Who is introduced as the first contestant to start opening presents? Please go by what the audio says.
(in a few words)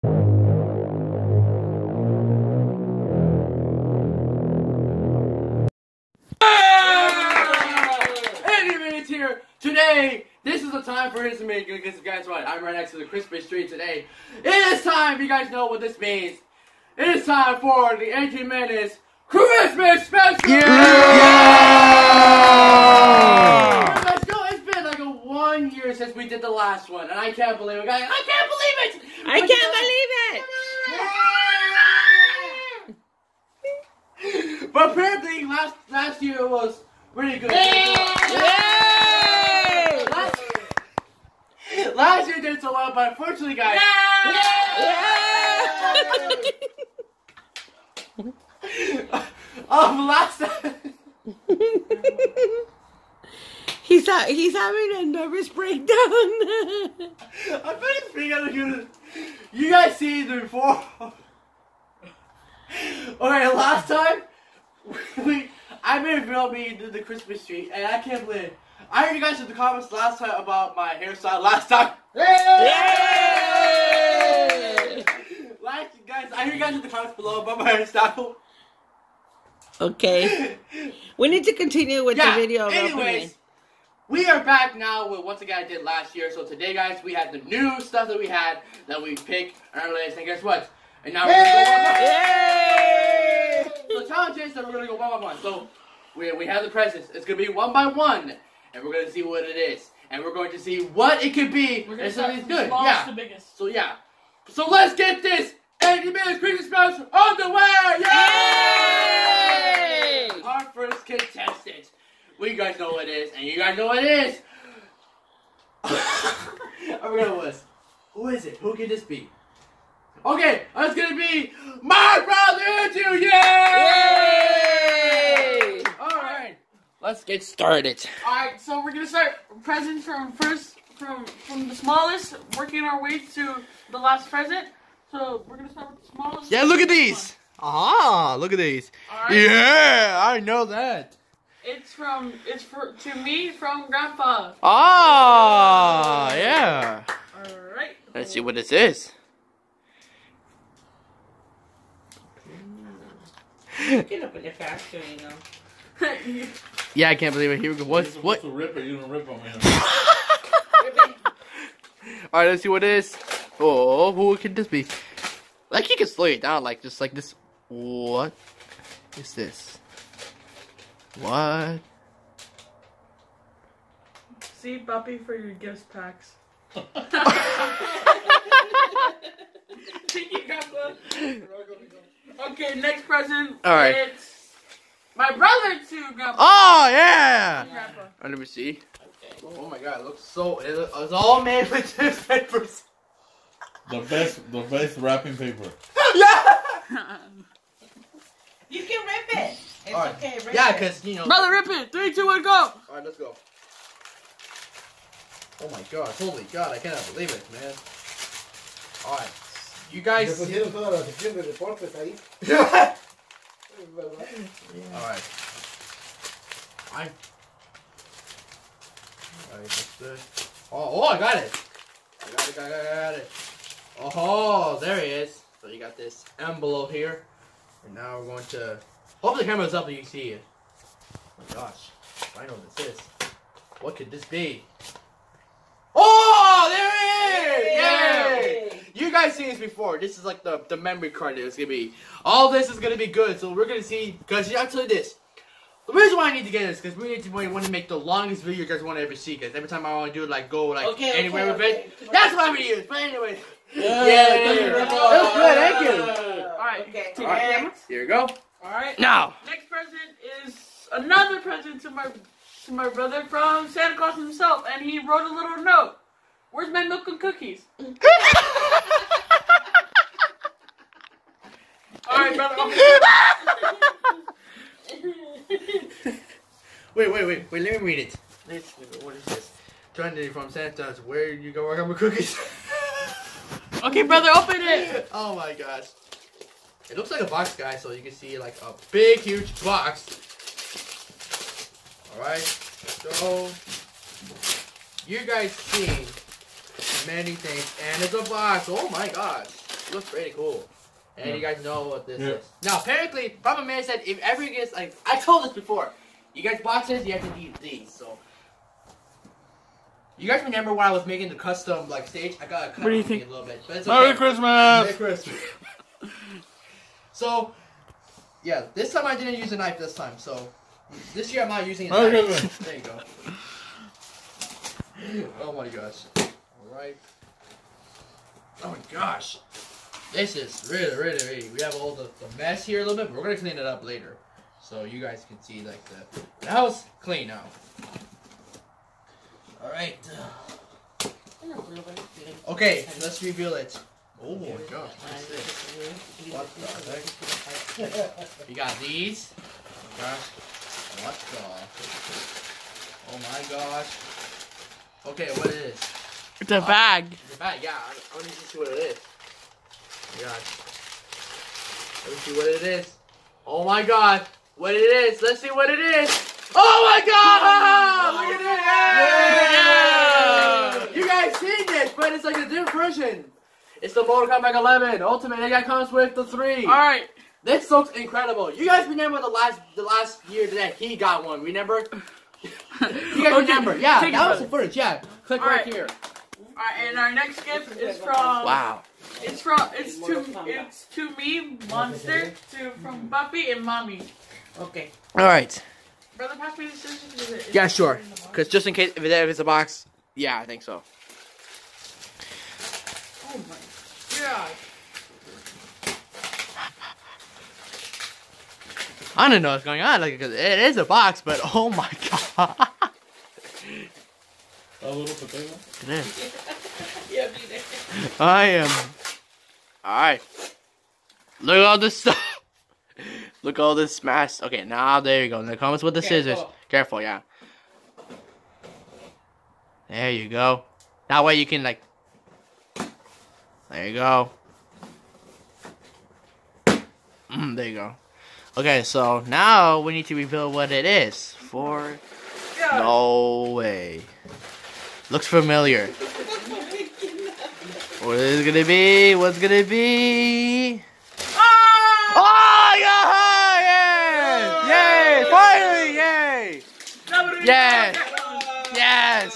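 Andrew.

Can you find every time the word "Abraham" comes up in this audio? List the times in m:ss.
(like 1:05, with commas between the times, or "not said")
not said.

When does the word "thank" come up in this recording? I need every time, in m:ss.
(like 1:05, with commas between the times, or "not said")
2:56, 4:15.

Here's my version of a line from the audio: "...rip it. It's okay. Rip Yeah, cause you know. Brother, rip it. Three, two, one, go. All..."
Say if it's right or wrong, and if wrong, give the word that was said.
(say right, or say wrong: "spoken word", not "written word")
right.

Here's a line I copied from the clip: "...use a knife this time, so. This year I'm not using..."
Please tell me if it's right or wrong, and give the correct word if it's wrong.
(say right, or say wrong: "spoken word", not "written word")
right.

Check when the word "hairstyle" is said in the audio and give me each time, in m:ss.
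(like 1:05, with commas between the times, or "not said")
1:10, 1:17.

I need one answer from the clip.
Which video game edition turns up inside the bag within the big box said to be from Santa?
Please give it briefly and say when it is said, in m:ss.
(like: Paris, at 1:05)
Mortal Kombat 11 Ultimate, at 6:14.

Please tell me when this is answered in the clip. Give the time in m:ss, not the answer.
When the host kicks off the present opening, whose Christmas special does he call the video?
1:45.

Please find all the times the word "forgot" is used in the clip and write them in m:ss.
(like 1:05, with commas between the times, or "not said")
1:56.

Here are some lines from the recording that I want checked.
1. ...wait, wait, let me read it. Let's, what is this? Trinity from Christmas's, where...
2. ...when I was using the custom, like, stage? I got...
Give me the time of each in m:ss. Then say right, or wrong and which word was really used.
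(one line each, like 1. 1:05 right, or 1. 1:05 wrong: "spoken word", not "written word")
1. 4:37 wrong: "Santa", not "Christmas"
2. 5:10 wrong: "making", not "using".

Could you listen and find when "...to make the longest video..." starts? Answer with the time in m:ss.
4:07.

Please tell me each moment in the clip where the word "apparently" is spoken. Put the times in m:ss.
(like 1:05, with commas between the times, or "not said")
0:34, 5:02.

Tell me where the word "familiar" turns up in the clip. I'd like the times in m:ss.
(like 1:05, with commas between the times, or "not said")
7:25.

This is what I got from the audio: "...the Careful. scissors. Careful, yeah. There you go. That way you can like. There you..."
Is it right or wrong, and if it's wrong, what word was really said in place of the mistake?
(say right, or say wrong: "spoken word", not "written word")
right.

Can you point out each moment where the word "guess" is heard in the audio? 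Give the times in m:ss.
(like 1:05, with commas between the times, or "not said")
0:11, 1:30.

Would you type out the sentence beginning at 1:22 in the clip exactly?
Anyways, we are back now with once again I did last year.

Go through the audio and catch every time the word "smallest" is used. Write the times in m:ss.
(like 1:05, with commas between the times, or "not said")
2:11, 2:16.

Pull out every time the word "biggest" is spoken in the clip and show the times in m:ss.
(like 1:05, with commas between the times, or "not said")
1:43.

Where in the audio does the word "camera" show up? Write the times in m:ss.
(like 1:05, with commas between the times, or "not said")
3:49.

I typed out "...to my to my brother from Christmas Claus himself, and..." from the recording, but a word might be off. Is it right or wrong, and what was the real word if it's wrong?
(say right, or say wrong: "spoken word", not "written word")
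wrong: "Santa", not "Christmas".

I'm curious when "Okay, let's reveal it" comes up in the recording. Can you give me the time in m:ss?
5:42.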